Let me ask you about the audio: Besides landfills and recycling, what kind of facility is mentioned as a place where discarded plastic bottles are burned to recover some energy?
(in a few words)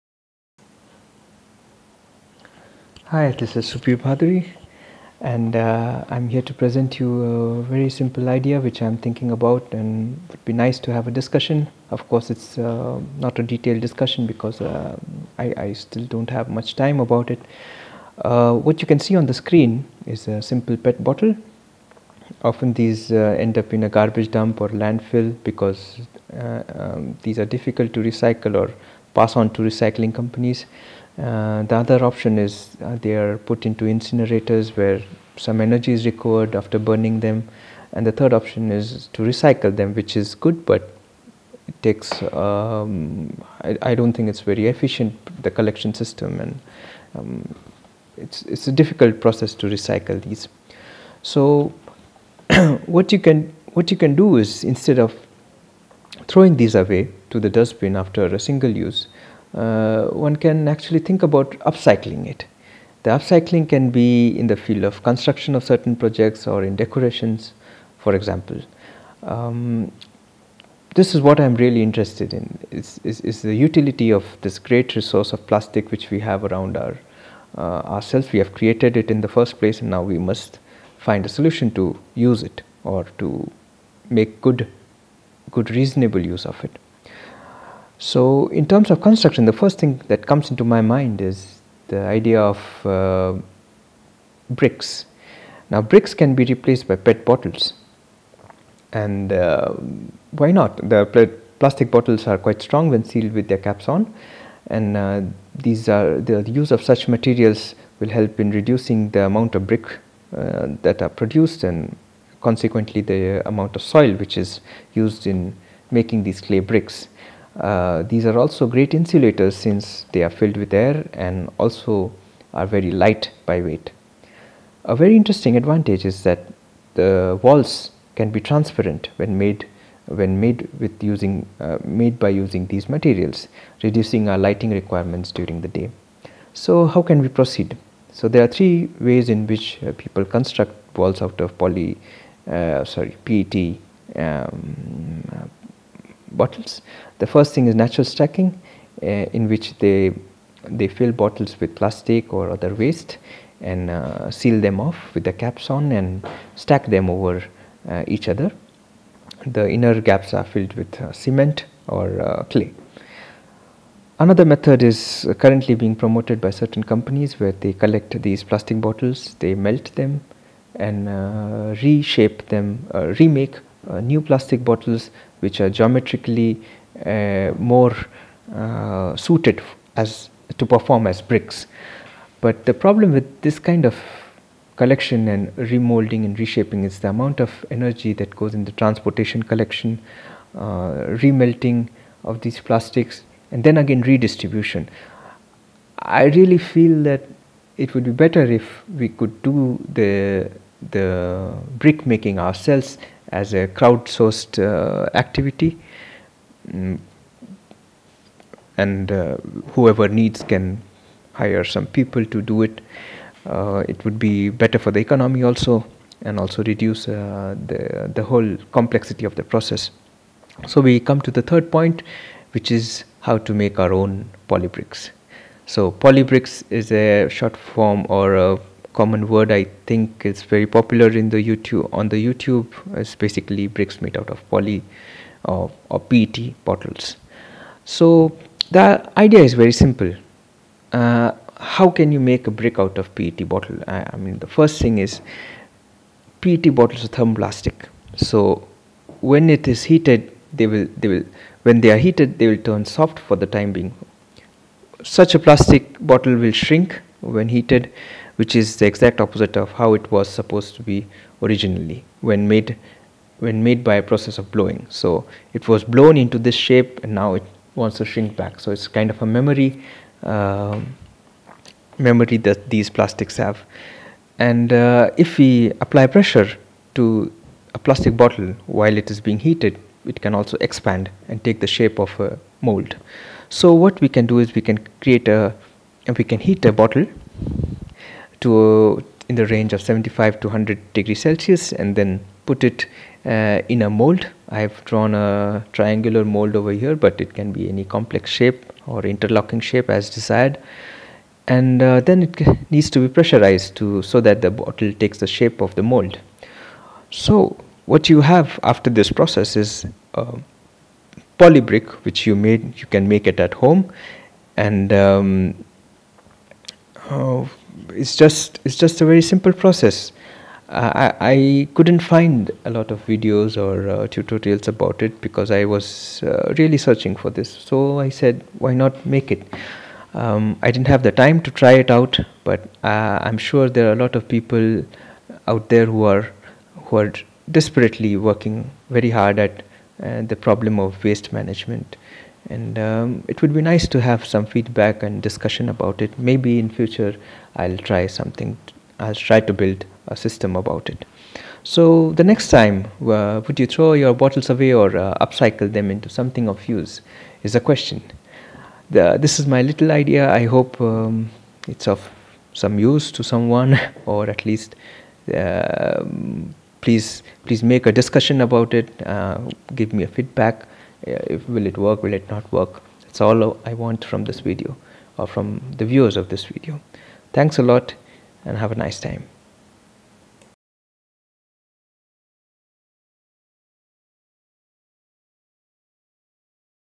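Incinerators.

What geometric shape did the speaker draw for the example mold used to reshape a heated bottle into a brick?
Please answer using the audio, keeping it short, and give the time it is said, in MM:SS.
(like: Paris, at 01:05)
Triangular, at 04:55.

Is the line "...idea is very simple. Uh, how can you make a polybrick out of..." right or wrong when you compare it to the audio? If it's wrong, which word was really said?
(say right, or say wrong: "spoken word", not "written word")
wrong: "brick", not "polybrick".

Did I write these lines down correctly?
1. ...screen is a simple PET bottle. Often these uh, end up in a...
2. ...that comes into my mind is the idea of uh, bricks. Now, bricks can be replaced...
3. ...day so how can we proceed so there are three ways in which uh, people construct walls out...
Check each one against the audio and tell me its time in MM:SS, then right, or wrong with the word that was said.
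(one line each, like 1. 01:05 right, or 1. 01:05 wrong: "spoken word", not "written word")
1. 00:19 right
2. 01:30 right
3. 02:15 right.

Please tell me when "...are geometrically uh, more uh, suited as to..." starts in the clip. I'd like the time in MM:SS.
02:55.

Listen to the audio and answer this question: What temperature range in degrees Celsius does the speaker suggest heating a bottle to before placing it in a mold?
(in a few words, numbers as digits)
75 to 100 degrees Celsius.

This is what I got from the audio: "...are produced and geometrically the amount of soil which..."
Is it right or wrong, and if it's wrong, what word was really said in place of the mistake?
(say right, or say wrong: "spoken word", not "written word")
wrong: "consequently", not "geometrically".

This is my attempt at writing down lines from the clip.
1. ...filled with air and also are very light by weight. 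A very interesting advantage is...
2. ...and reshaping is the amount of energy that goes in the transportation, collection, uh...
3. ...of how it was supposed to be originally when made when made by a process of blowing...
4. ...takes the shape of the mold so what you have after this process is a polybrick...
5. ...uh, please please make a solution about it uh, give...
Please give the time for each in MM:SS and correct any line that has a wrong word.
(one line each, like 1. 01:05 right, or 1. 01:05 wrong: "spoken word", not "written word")
1. 02:00 right
2. 03:06 right
3. 04:19 right
4. 05:04 right
5. 06:05 wrong: "discussion", not "solution".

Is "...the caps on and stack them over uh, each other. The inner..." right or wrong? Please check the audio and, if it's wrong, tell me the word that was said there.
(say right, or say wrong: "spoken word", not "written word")
right.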